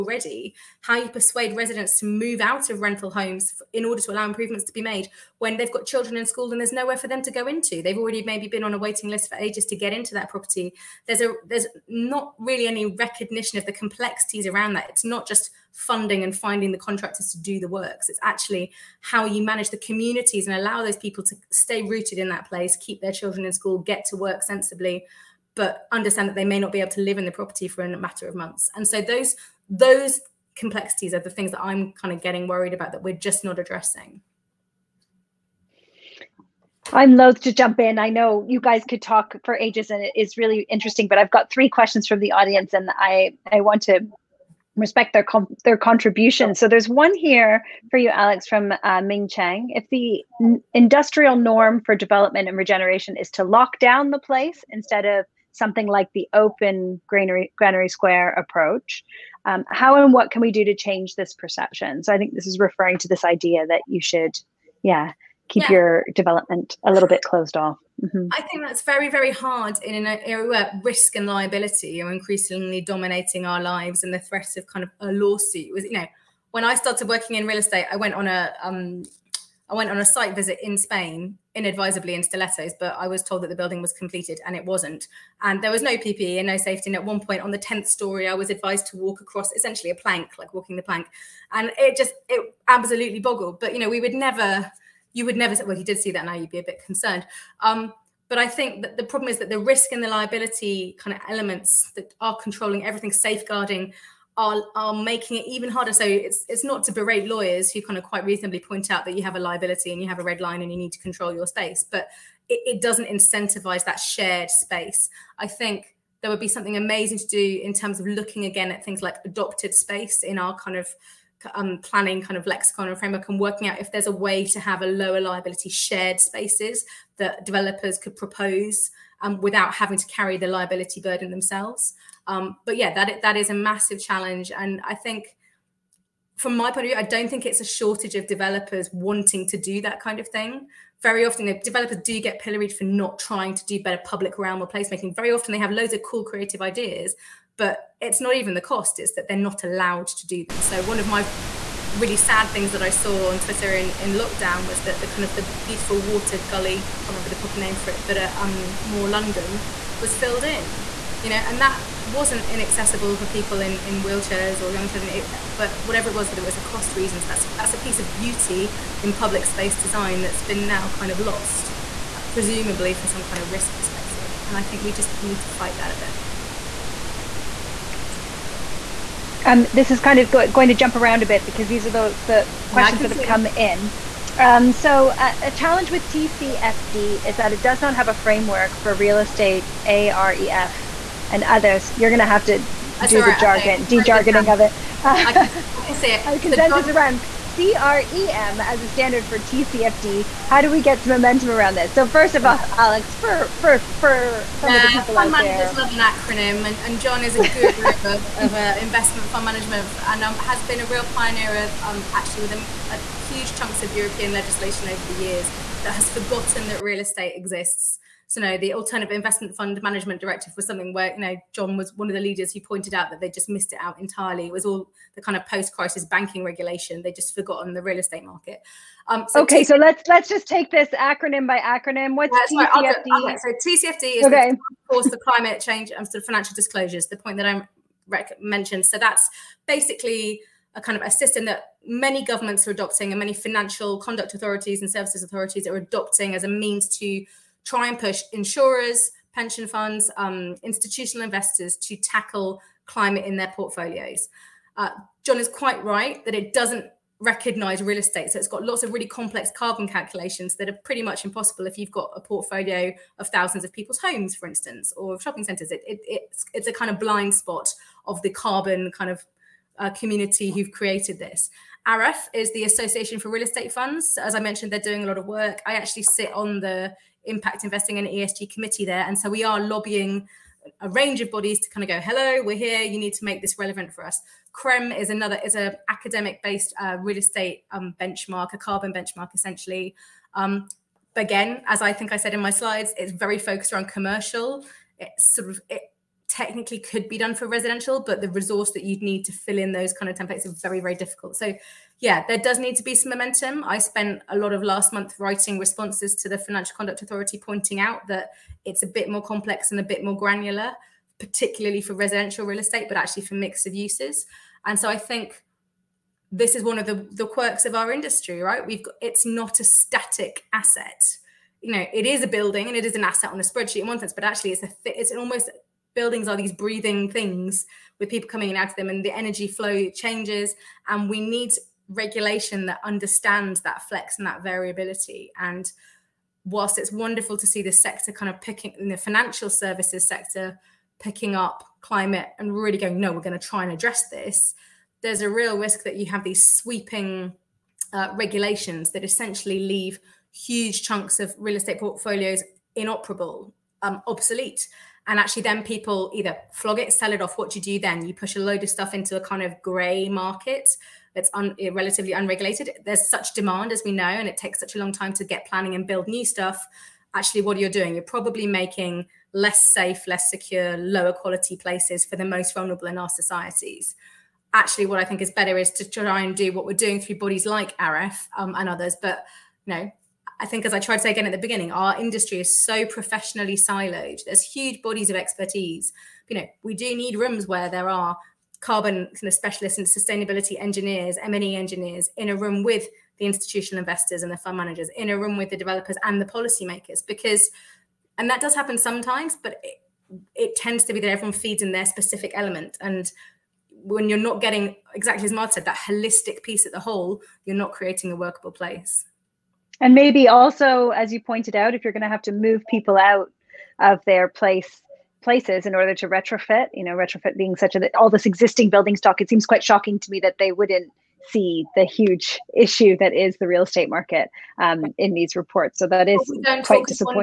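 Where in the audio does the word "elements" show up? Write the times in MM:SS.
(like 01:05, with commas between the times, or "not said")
01:41, 06:42.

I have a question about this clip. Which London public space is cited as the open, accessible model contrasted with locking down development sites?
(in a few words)
Granary Square.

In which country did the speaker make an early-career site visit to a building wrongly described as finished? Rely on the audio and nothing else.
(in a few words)
Spain.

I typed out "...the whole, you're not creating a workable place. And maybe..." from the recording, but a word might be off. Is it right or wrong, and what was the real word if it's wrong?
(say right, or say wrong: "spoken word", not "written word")
right.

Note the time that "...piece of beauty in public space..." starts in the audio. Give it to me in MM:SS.
02:47.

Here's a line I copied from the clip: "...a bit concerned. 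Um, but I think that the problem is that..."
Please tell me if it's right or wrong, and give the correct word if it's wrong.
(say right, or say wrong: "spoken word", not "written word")
right.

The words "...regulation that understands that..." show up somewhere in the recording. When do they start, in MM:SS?
05:31.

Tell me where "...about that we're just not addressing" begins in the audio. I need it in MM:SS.
00:32.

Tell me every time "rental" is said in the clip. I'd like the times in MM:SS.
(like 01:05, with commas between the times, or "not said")
00:02.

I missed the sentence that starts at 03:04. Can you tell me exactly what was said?
Um, so uh, a challenge with TCFD is that it does not have a framework for real estate AREF and others.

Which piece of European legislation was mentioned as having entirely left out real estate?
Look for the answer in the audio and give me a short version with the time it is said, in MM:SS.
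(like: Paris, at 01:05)
Alternative Investment Fund Management Directive, at 03:38.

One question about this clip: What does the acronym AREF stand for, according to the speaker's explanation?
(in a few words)
Association for Real Estate Funds.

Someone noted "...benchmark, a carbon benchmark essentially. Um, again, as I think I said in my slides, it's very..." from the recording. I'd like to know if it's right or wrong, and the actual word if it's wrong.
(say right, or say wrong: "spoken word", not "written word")
right.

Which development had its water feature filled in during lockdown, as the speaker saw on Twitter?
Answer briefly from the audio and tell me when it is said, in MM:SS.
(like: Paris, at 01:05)
More London, at 02:38.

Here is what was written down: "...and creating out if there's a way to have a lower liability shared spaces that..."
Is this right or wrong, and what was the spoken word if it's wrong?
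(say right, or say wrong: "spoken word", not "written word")
wrong: "working", not "creating".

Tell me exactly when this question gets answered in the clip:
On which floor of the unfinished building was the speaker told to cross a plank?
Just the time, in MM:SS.
01:27.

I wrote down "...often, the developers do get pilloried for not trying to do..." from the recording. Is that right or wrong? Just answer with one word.
right.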